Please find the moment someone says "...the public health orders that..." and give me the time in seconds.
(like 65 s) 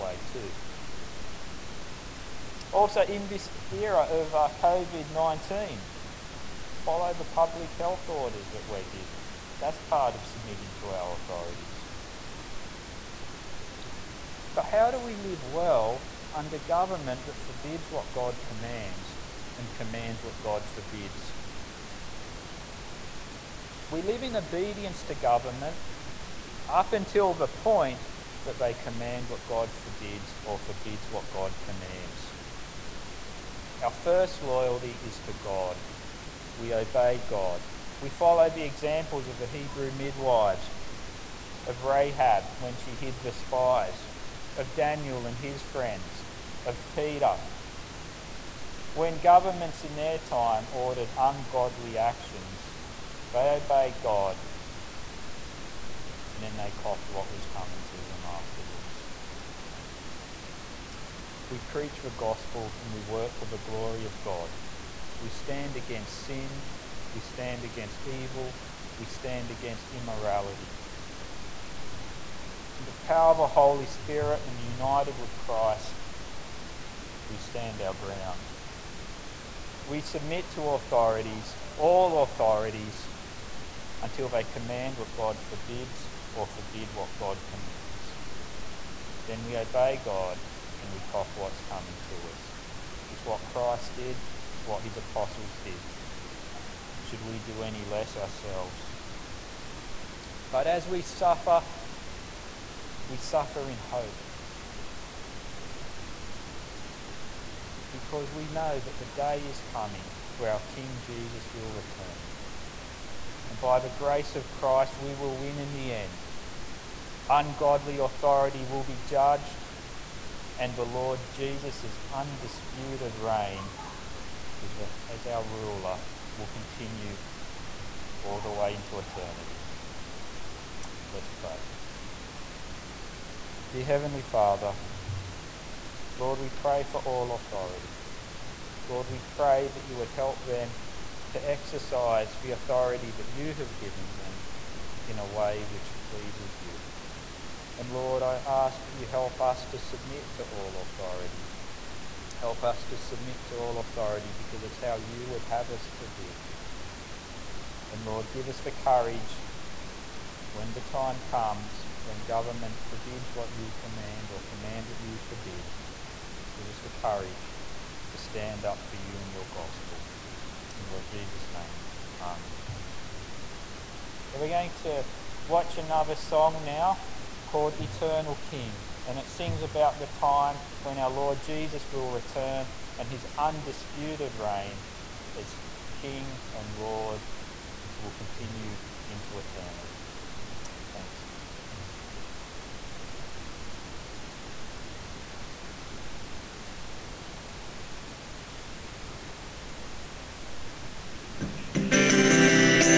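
7 s.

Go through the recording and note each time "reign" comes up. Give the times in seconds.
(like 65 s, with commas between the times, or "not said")
123 s, 184 s.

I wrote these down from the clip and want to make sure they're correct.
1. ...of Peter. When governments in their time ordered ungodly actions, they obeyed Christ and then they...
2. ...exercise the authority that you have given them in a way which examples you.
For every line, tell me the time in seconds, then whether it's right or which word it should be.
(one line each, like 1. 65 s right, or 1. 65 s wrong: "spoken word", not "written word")
1. 46 s wrong: "God", not "Christ"
2. 141 s wrong: "pleases", not "examples".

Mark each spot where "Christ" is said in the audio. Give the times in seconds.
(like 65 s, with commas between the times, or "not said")
75 s, 93 s, 114 s.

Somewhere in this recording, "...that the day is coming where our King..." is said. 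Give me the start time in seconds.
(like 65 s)
108 s.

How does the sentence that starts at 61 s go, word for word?
We preach the gospel and we work for the glory of God.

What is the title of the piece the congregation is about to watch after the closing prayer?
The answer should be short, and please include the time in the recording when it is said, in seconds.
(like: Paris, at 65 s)
Eternal King, at 177 s.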